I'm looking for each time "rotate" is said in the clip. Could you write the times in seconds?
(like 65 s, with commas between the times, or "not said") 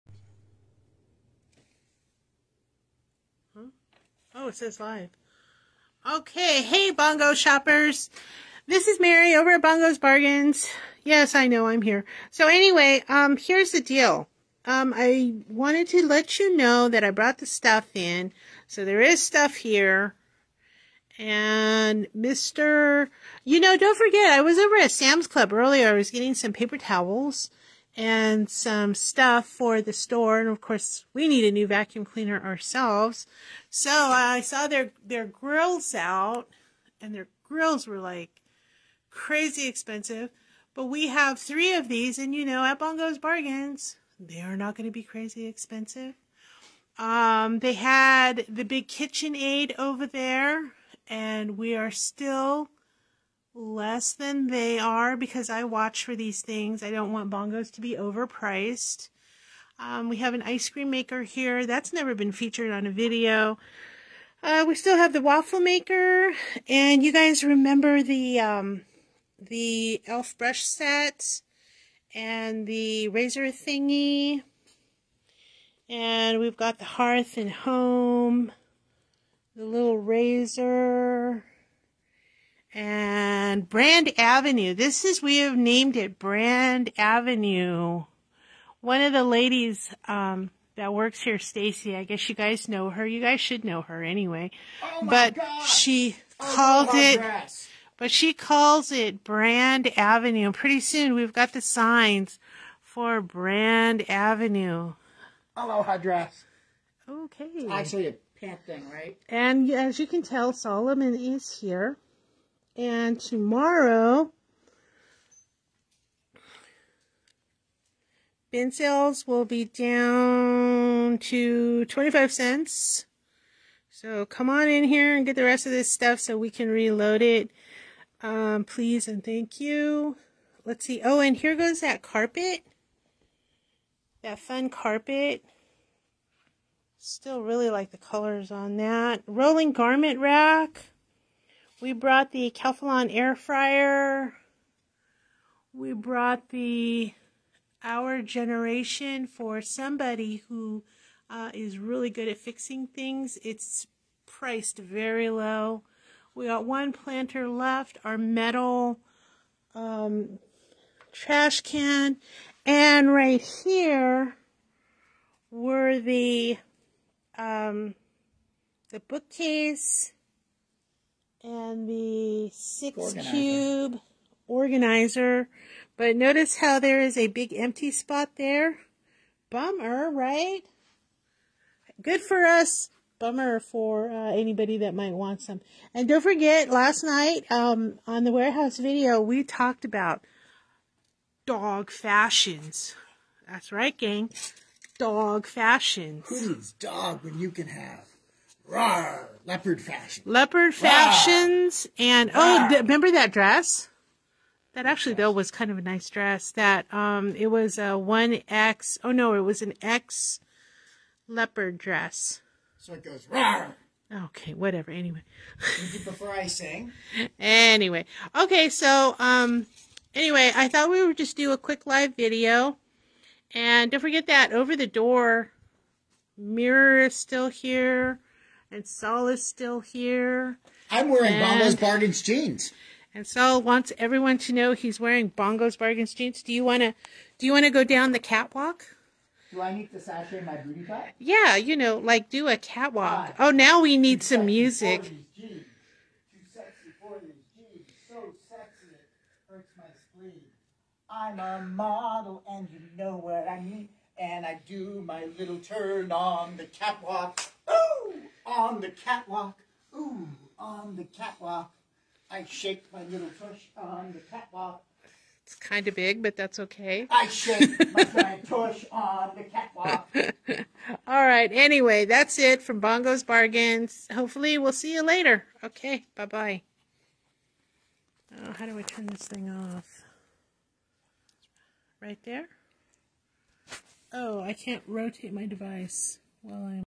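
284 s.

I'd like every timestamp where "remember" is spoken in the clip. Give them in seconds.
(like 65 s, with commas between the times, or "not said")
67 s, 202 s.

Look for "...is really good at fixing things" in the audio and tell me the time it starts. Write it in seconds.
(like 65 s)
151 s.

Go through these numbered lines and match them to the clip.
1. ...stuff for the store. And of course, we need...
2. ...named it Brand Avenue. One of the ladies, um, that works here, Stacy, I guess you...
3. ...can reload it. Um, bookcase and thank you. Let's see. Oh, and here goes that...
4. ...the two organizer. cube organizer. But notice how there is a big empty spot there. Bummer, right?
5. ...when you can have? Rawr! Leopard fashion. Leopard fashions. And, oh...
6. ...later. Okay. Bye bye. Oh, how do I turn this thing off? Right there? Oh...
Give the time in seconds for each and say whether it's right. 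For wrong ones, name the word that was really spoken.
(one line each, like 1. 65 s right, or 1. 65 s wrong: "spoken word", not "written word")
1. 28 s right
2. 85 s right
3. 126 s wrong: "please", not "bookcase"
4. 171 s wrong: "six", not "two"
5. 197 s right
6. 275 s right.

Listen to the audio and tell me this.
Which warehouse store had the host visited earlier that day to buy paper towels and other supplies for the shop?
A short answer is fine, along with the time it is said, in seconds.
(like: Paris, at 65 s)
Sam's Club, at 24 s.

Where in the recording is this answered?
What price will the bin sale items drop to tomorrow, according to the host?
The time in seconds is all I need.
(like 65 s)
121 s.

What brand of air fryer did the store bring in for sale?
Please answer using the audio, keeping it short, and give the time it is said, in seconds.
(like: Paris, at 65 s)
Calphalon, at 142 s.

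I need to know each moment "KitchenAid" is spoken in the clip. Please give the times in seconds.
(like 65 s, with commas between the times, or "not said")
48 s.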